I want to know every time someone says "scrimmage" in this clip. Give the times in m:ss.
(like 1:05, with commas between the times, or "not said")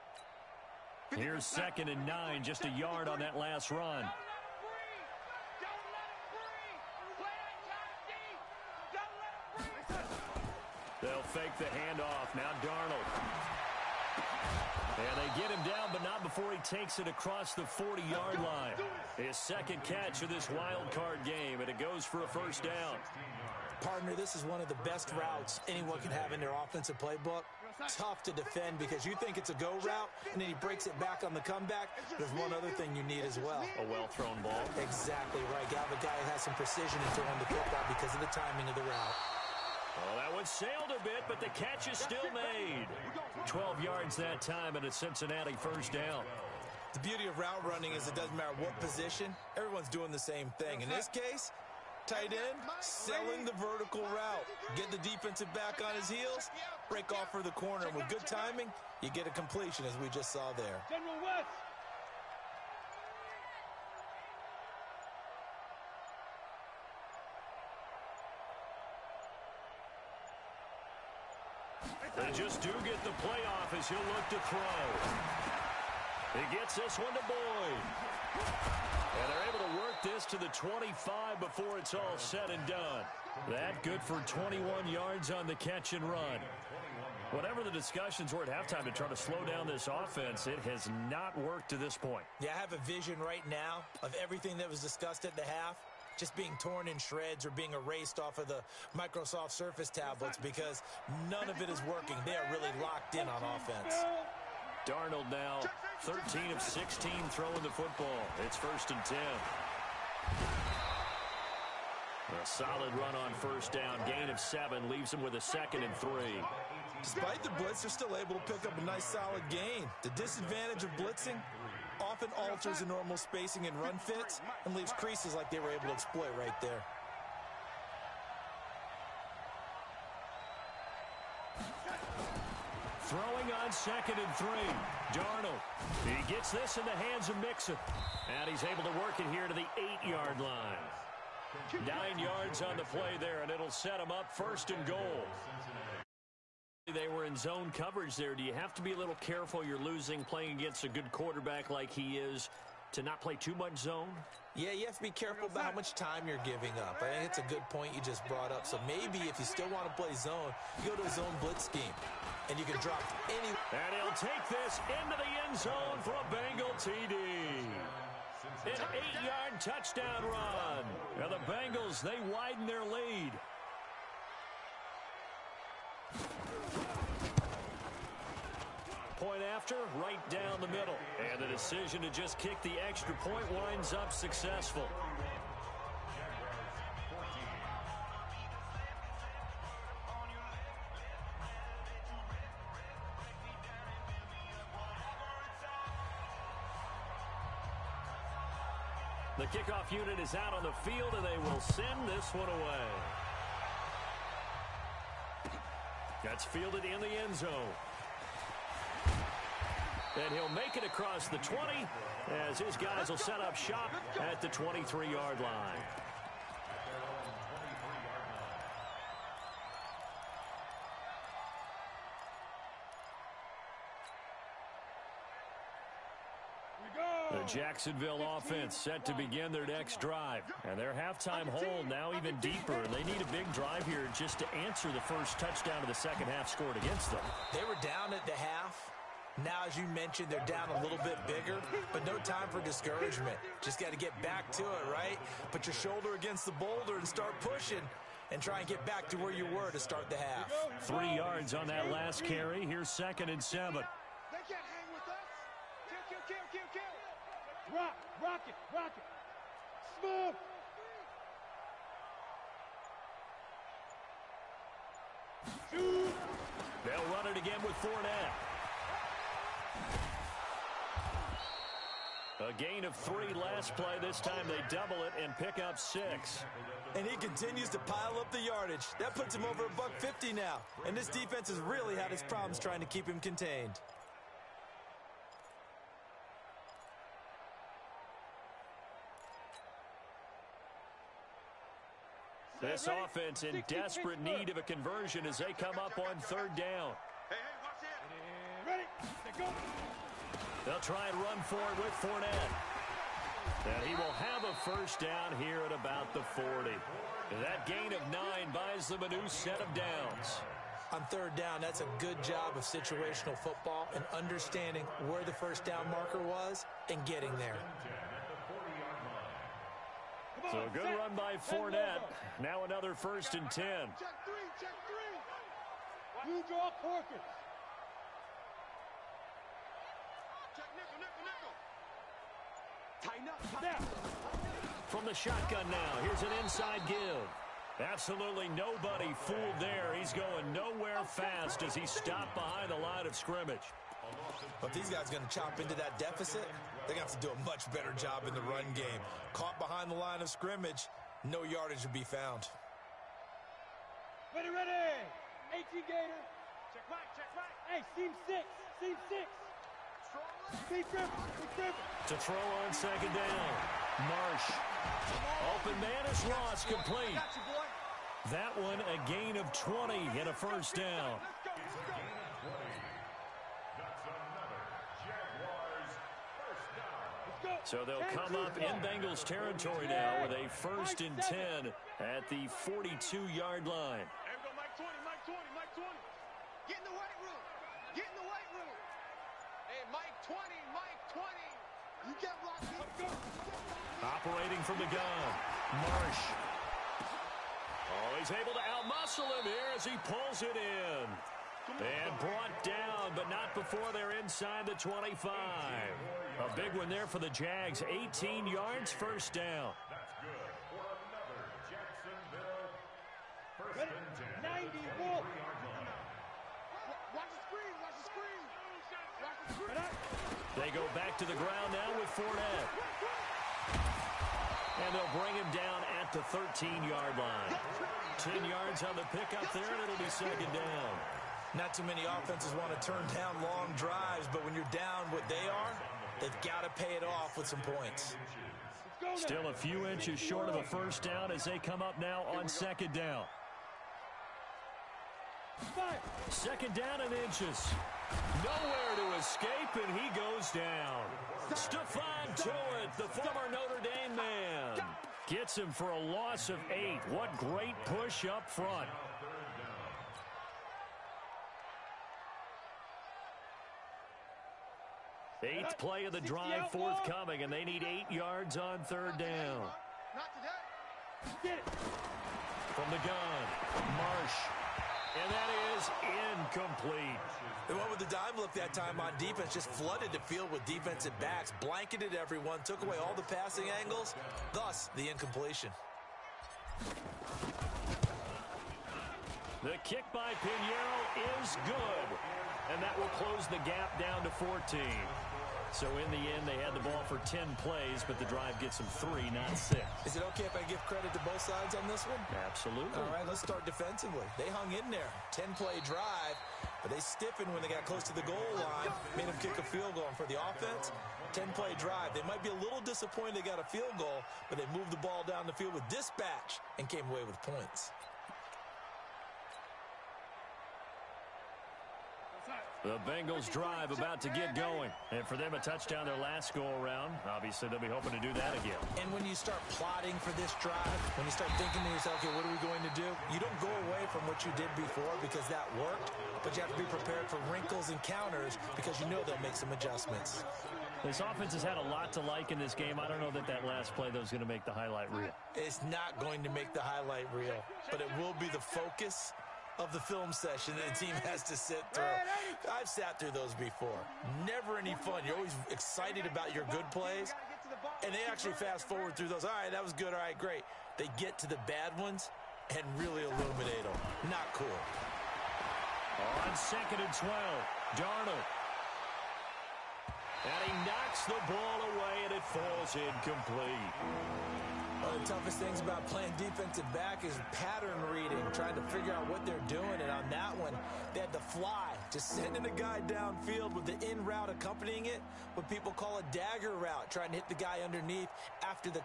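5:43, 5:50.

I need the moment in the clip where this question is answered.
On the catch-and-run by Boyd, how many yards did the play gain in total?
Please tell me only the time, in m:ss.
1:24.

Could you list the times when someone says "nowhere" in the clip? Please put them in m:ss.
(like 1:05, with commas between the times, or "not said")
5:40, 7:28.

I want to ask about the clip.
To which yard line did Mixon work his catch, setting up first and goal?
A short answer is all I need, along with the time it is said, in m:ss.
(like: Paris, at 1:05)
8, at 2:19.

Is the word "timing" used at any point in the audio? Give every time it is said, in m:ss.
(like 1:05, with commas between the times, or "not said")
0:38, 0:58.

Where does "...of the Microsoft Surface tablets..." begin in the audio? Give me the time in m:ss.
1:38.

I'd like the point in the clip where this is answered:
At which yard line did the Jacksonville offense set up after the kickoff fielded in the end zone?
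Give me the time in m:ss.
3:34.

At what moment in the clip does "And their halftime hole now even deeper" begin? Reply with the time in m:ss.
3:50.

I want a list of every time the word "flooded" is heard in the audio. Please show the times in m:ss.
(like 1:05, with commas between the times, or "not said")
7:59.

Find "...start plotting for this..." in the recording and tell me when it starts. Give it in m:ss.
8:49.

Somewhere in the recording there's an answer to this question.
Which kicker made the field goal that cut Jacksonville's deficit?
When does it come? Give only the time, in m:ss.
8:10.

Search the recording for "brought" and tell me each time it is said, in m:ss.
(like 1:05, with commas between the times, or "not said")
2:38, 6:42.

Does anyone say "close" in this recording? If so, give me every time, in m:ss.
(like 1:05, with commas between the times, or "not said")
8:13, 8:27.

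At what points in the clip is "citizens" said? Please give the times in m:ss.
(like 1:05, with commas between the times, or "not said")
not said.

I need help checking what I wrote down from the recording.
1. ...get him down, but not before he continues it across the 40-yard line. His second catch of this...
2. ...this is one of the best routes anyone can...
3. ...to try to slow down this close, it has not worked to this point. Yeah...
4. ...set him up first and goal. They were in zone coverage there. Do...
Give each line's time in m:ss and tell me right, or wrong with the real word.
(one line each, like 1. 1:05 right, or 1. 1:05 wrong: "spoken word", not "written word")
1. 0:15 wrong: "takes", not "continues"
2. 0:24 right
3. 1:28 wrong: "offense", not "close"
4. 2:23 right.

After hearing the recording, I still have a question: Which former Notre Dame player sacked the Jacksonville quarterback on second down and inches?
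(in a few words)
Stephon Tuitt.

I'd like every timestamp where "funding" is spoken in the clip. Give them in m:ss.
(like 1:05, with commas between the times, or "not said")
not said.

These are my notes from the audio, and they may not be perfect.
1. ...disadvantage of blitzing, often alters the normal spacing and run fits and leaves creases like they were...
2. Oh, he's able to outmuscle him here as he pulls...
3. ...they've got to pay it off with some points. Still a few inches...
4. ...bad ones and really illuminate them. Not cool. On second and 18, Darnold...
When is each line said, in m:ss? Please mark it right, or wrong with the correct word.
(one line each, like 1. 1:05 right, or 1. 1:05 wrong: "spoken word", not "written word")
1. 2:00 right
2. 6:37 right
3. 7:16 right
4. 9:21 wrong: "12", not "18".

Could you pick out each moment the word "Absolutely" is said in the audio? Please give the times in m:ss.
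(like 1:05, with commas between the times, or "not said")
5:37, 8:22.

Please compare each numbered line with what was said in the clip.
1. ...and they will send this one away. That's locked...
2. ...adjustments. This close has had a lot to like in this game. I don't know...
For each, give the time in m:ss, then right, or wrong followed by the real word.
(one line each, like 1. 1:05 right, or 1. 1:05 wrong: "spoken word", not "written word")
1. 3:21 wrong: "fielded", not "locked"
2. 8:59 wrong: "offense", not "close".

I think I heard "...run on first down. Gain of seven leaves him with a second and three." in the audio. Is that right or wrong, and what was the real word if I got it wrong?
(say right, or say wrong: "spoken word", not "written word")
right.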